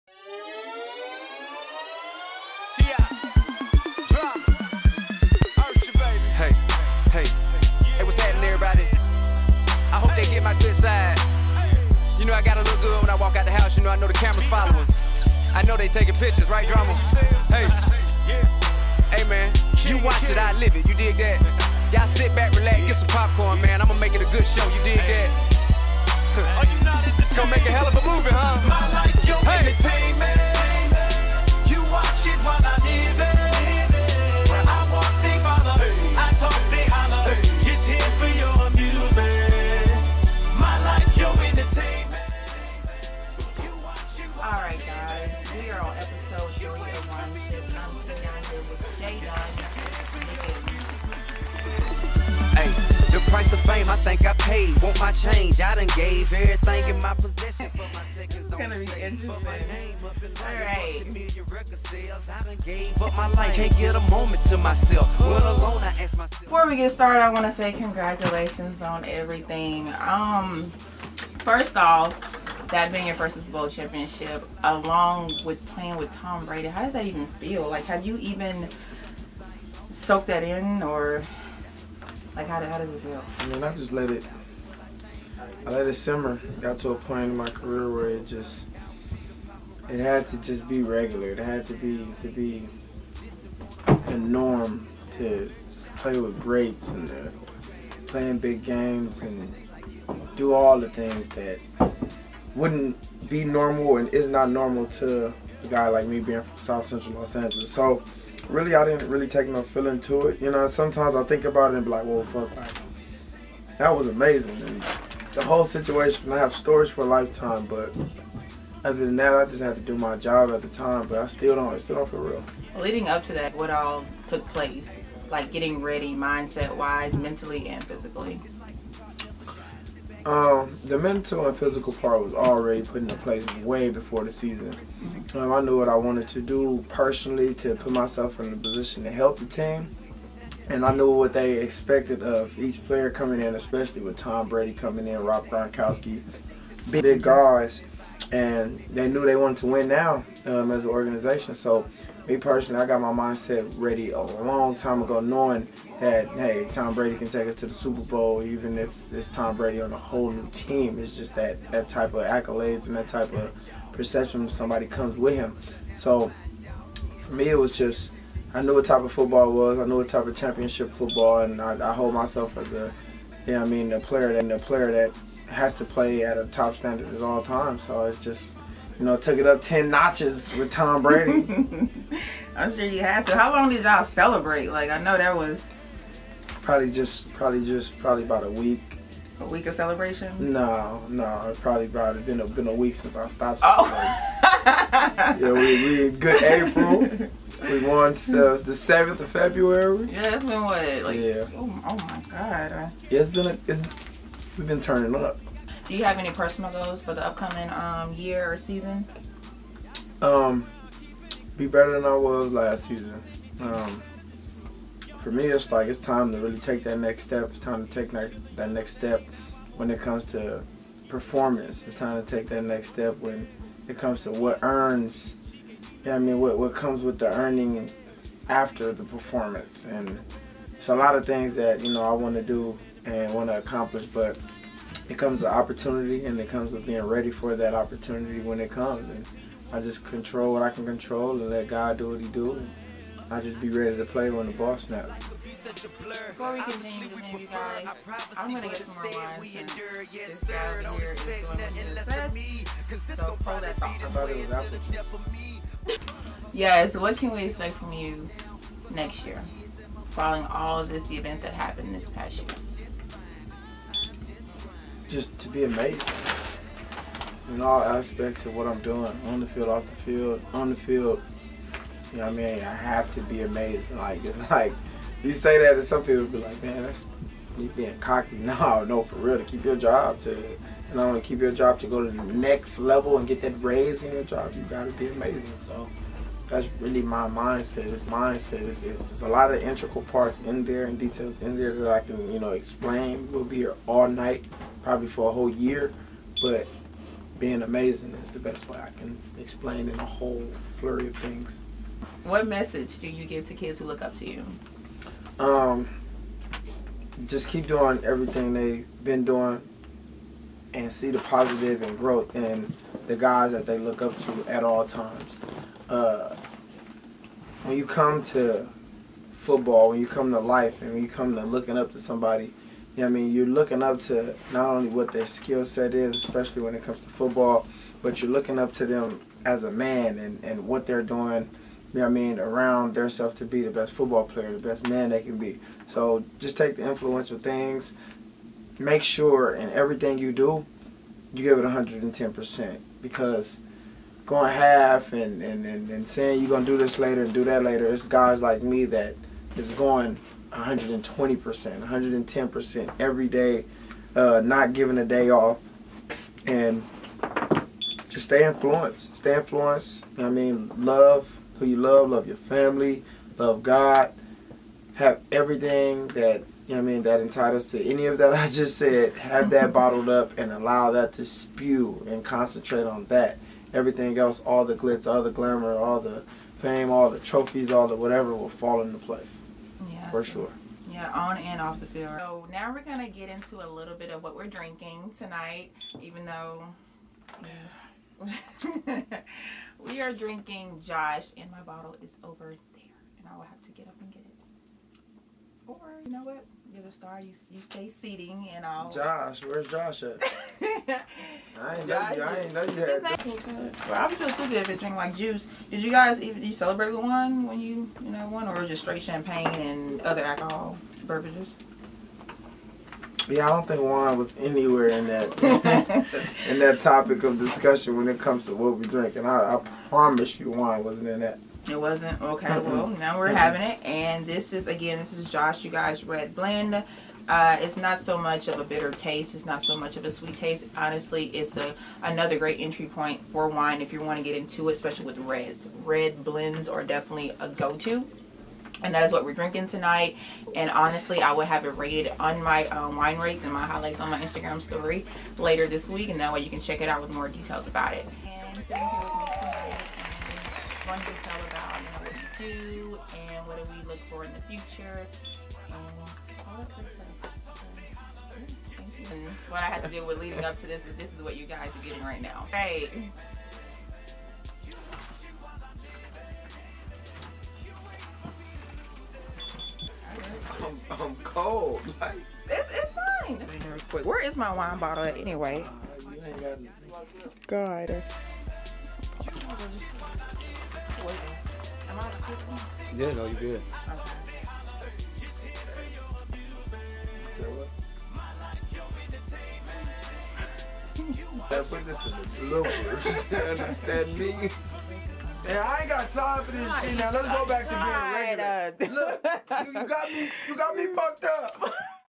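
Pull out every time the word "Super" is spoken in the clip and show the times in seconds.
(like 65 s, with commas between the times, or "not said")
73 s, 157 s.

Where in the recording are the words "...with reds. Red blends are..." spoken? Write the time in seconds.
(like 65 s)
435 s.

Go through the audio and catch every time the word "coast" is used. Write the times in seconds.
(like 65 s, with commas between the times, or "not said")
not said.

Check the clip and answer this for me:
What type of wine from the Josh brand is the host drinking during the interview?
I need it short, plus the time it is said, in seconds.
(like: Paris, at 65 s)
Red Blend, at 426 s.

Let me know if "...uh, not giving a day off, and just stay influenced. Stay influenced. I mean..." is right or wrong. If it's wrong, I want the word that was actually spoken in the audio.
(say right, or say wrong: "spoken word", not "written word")
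right.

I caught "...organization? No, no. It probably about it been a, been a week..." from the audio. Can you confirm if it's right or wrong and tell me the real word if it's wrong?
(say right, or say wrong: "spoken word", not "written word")
wrong: "celebration", not "organization".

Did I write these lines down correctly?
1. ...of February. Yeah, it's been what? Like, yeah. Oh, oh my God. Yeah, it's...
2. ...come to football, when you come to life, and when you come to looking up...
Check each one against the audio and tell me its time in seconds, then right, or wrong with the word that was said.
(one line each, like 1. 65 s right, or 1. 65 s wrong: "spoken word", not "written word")
1. 199 s right
2. 317 s right.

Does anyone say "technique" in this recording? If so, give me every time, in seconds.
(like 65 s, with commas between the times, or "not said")
not said.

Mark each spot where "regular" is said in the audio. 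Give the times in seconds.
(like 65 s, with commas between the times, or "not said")
90 s, 498 s.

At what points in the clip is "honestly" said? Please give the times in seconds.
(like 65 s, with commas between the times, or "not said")
430 s, 440 s.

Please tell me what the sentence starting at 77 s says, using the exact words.
Like, have you even soak that in or like how, how does it feel?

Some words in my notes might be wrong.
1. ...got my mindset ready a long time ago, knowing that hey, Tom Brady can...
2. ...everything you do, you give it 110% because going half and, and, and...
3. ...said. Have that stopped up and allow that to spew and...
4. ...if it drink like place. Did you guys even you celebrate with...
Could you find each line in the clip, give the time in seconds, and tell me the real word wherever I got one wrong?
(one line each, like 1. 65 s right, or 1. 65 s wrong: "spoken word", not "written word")
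1. 152 s right
2. 339 s right
3. 368 s wrong: "bottled", not "stopped"
4. 404 s wrong: "juice", not "place".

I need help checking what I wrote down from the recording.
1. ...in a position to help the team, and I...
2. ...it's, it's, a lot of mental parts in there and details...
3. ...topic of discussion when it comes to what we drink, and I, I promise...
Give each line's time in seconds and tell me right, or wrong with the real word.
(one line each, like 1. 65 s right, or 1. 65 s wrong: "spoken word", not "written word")
1. 138 s right
2. 288 s wrong: "integral", not "mental"
3. 416 s right.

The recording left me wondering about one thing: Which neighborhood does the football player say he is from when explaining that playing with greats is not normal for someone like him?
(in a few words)
South Central Los Angeles.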